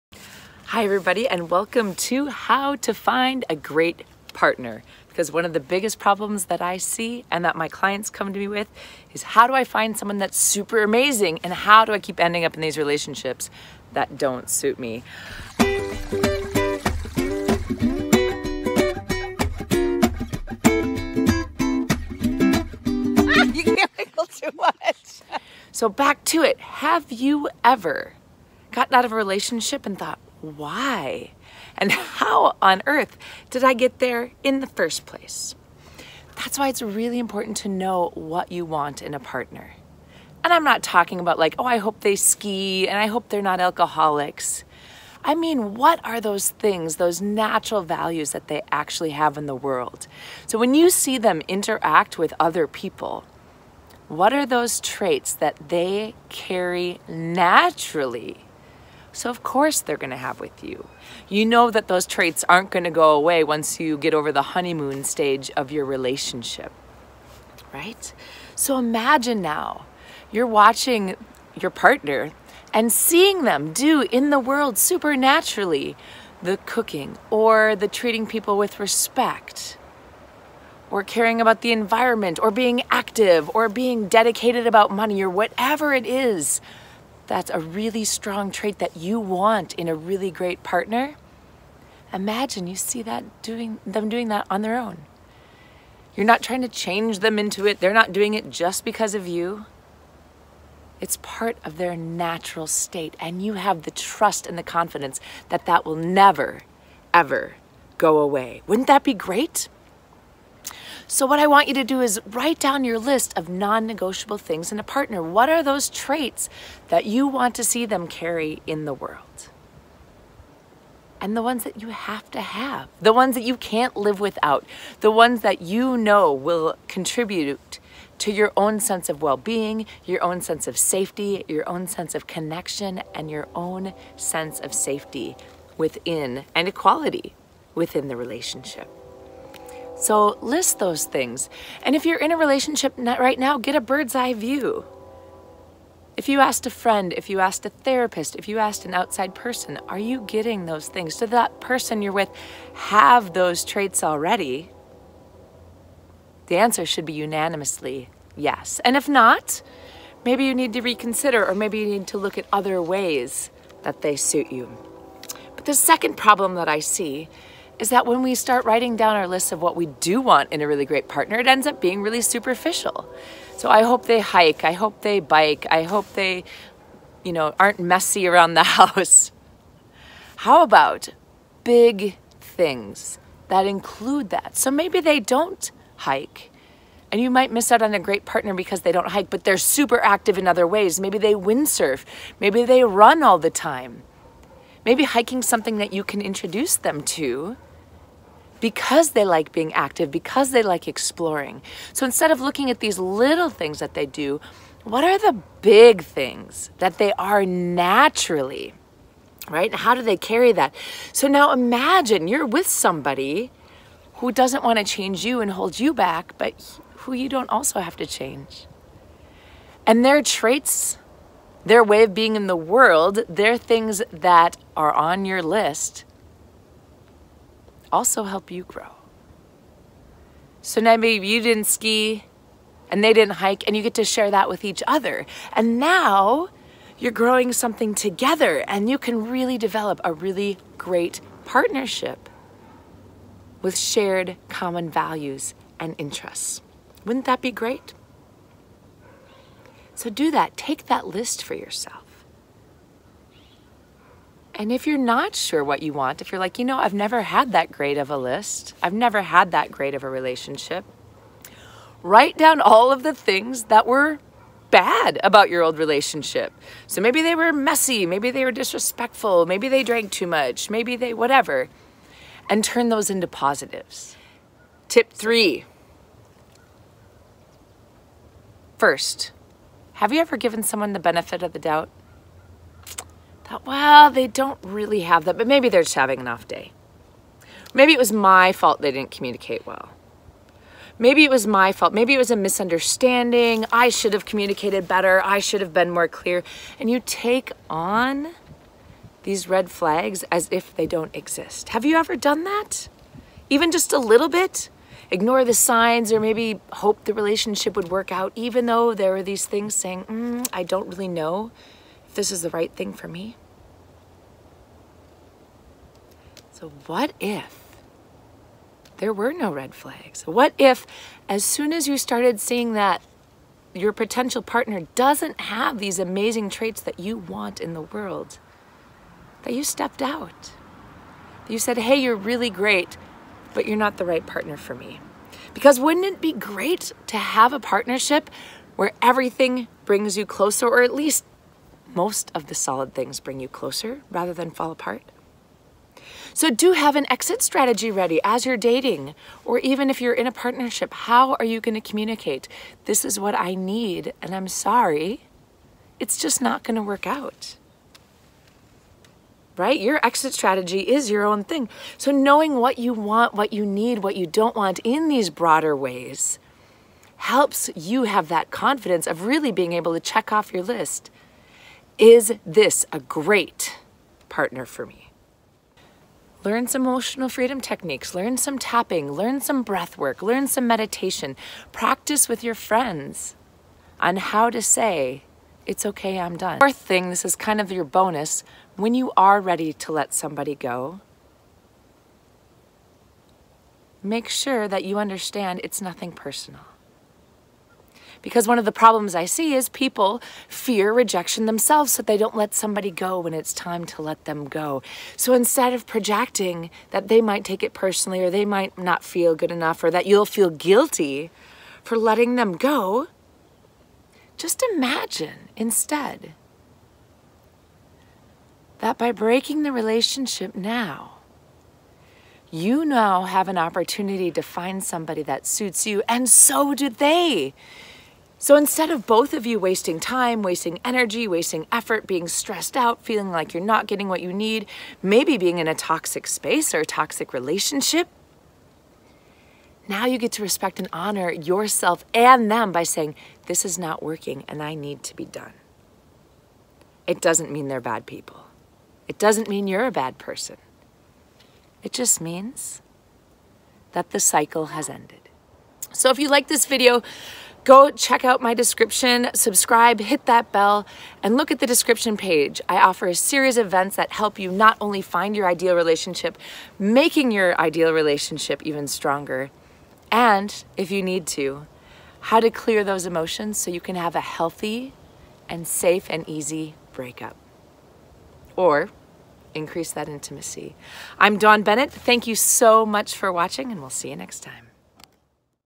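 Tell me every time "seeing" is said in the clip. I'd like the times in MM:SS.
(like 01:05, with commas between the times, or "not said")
01:12, 05:22.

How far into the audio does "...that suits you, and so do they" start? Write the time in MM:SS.
07:05.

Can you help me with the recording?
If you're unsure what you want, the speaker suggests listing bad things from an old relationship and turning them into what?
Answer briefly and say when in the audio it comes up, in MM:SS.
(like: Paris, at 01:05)
positives, at 04:33.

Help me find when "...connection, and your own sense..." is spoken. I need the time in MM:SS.
02:12.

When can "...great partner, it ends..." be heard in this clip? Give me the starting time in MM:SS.
02:50.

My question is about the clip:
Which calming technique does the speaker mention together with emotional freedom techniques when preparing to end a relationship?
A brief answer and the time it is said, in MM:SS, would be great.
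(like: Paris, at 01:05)
tapping, at 06:18.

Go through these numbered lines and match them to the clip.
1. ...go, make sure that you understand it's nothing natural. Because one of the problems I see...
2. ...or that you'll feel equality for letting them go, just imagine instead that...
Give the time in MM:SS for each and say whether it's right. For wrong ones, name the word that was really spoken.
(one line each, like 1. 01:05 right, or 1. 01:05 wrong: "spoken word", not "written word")
1. 06:30 wrong: "personal", not "natural"
2. 06:49 wrong: "guilty", not "equality".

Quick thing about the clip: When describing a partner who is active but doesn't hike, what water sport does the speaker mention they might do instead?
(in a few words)
windsurf.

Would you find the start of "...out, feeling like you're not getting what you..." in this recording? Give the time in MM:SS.
07:12.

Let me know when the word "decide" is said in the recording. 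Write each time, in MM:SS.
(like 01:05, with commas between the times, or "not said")
not said.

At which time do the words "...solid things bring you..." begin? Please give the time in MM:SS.
05:42.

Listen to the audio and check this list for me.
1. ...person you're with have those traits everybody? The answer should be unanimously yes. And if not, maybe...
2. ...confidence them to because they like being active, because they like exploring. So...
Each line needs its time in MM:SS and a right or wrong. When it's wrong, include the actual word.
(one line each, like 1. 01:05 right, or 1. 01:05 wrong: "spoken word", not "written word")
1. 02:31 wrong: "already", not "everybody"
2. 03:16 wrong: "introduce", not "confidence".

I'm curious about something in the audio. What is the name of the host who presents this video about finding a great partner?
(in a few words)
Dawn Bennett.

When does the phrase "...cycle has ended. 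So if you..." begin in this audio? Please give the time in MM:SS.
07:34.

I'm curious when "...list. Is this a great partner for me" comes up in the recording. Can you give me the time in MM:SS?
06:10.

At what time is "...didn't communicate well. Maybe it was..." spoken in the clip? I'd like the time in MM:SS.
04:48.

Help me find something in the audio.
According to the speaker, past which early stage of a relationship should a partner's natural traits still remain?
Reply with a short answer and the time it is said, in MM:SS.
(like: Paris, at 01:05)
honeymoon stage, at 01:04.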